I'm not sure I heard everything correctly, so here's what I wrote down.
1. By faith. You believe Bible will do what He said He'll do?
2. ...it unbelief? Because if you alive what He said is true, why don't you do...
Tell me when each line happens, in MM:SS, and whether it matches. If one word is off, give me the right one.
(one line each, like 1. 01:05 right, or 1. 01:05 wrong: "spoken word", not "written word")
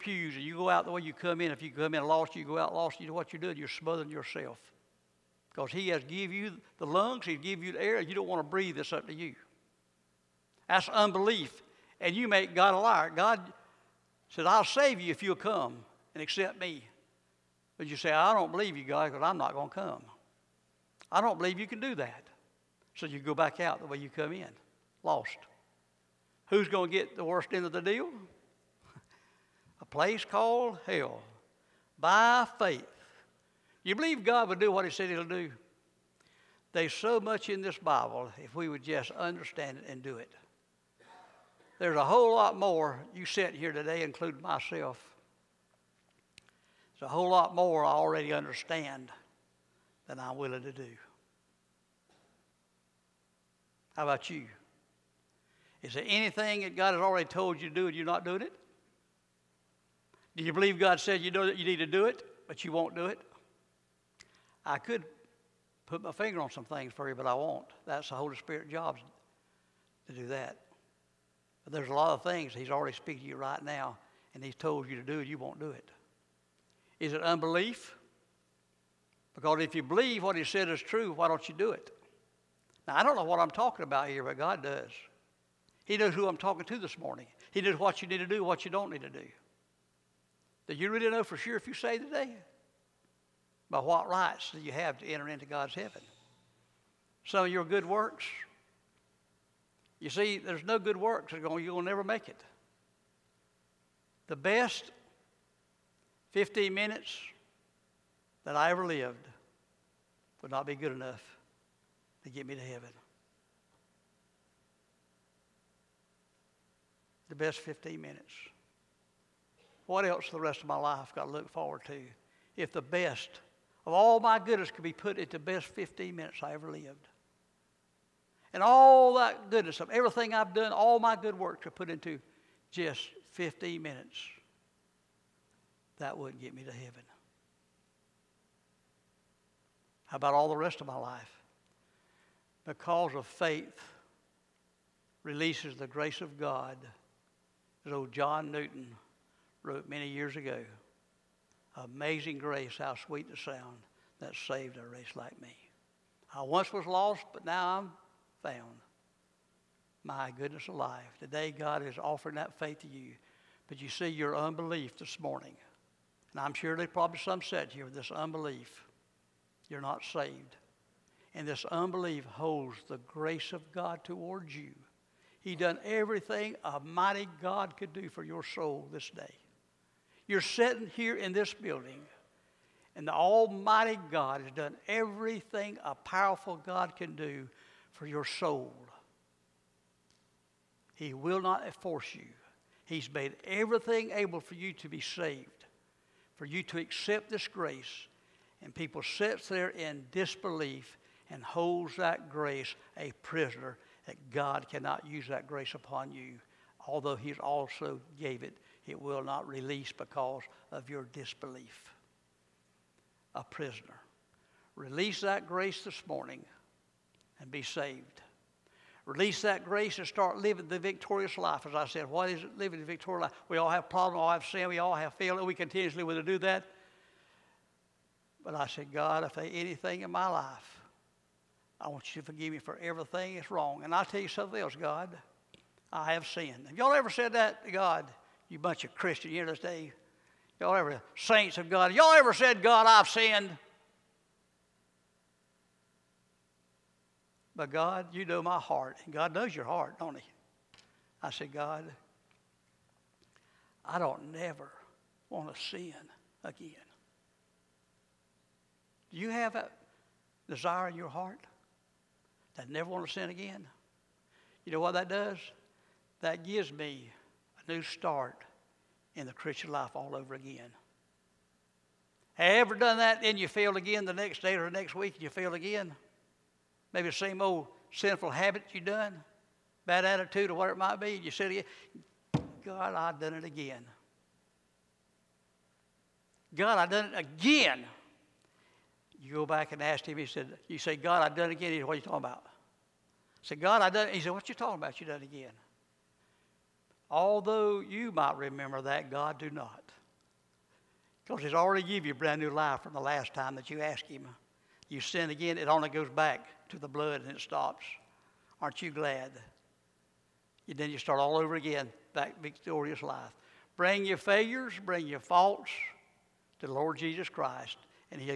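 1. 00:31 wrong: "God", not "Bible"
2. 01:17 wrong: "believe", not "alive".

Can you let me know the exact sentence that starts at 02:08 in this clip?
And all that goodness of everything I've done, all my good work to put into just 15 minutes.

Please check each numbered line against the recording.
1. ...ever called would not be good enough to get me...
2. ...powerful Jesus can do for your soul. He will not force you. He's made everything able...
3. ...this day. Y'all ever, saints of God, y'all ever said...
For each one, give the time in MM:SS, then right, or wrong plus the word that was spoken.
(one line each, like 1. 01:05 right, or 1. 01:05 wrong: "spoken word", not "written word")
1. 01:48 wrong: "lived", not "called"
2. 03:05 wrong: "God", not "Jesus"
3. 03:59 right.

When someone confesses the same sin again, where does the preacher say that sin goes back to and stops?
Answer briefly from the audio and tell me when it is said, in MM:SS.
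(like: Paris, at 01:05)
The blood, at 05:06.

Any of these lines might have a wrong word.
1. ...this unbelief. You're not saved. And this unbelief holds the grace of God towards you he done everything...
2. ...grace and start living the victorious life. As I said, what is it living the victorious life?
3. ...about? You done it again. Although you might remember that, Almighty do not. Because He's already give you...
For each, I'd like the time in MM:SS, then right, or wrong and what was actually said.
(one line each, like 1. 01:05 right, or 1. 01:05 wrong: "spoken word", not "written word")
1. 02:47 right
2. 03:39 right
3. 04:54 wrong: "God", not "Almighty".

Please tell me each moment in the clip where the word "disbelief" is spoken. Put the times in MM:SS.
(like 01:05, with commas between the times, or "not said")
03:20, 03:31.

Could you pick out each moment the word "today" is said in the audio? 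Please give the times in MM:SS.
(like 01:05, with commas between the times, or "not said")
00:43, 01:31, 02:41.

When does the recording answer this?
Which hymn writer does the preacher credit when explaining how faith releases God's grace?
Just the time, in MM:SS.
02:28.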